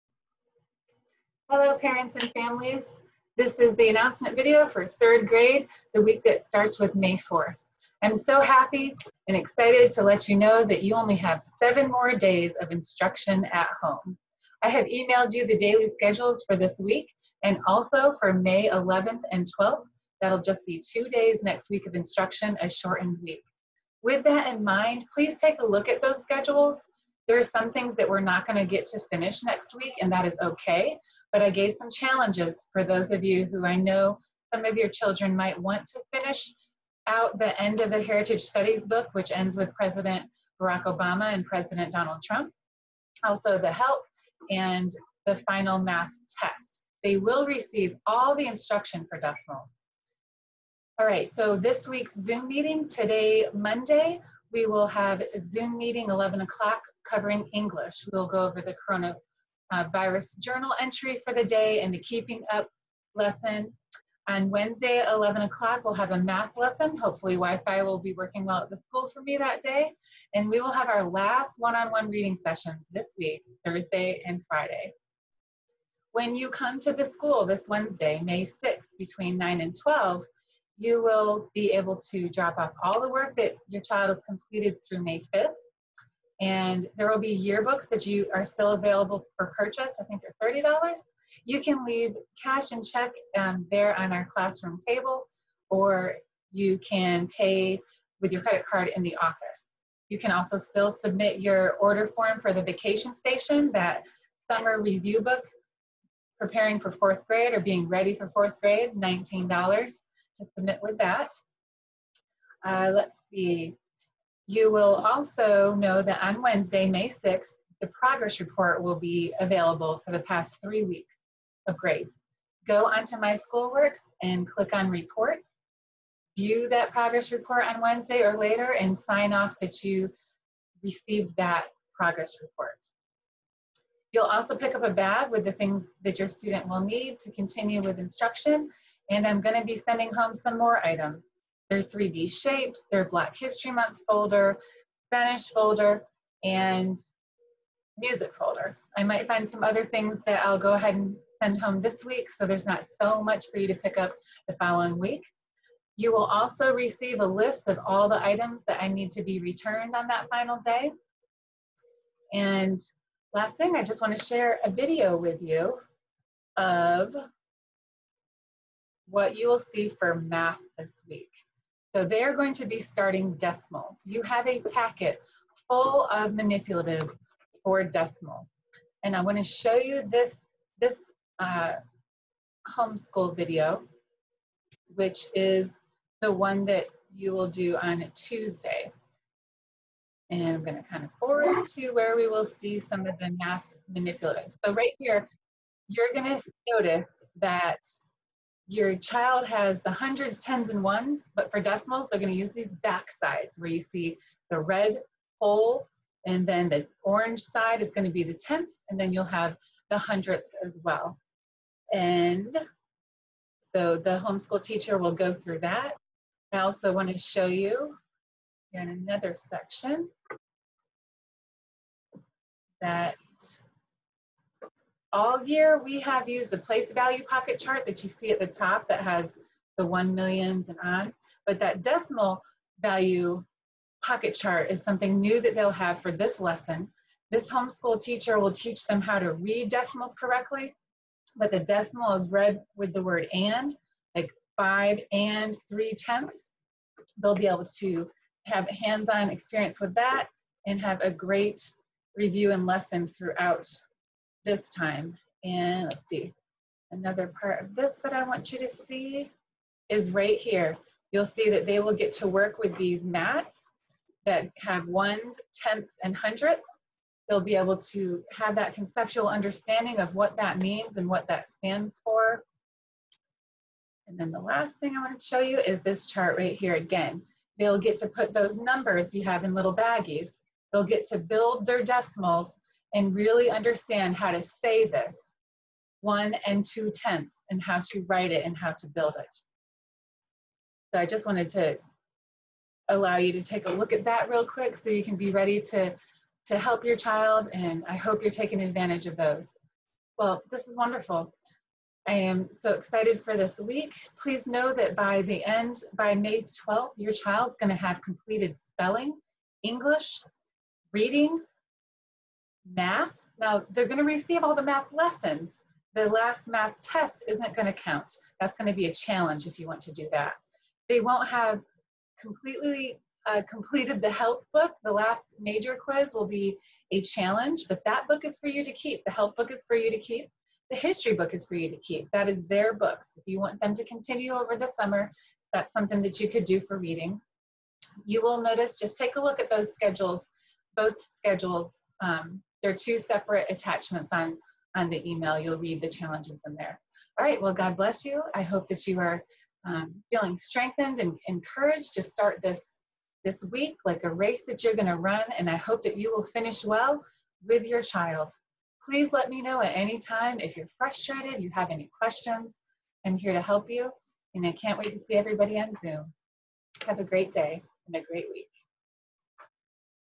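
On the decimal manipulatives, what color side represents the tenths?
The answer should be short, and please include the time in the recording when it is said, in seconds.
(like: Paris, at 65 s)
orange, at 207 s.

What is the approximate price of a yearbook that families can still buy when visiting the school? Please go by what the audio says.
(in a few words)
$30.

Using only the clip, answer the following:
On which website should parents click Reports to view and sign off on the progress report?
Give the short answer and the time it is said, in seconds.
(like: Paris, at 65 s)
My Schoolworks, at 123 s.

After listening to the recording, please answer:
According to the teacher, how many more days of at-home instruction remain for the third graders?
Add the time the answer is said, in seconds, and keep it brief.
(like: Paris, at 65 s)
7, at 11 s.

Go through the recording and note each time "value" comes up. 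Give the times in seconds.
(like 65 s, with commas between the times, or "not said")
226 s, 232 s.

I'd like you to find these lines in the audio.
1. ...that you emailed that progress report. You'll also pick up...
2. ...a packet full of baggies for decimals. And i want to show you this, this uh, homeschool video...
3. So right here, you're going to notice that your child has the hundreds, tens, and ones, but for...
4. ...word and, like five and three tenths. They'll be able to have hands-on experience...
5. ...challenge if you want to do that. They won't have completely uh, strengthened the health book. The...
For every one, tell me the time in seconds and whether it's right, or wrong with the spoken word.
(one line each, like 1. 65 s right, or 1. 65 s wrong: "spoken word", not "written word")
1. 129 s wrong: "received", not "emailed"
2. 174 s wrong: "manipulatives", not "baggies"
3. 194 s right
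4. 243 s right
5. 318 s wrong: "completed", not "strengthened".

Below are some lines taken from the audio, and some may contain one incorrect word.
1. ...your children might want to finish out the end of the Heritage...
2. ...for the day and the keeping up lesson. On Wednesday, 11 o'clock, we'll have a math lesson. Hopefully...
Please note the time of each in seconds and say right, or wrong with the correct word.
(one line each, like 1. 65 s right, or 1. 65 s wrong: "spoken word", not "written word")
1. 34 s right
2. 61 s right.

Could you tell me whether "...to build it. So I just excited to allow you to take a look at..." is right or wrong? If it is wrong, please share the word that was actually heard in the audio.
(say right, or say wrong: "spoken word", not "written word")
wrong: "wanted", not "excited".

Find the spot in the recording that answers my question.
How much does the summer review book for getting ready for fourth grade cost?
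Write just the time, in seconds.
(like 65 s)
108 s.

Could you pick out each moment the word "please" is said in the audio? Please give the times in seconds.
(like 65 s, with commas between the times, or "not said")
25 s, 304 s, 358 s.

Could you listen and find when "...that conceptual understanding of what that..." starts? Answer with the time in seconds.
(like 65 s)
268 s.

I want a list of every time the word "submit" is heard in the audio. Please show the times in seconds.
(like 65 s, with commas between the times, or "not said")
100 s, 110 s.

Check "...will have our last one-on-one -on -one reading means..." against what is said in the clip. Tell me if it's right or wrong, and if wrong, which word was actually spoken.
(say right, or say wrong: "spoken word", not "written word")
wrong: "sessions", not "means".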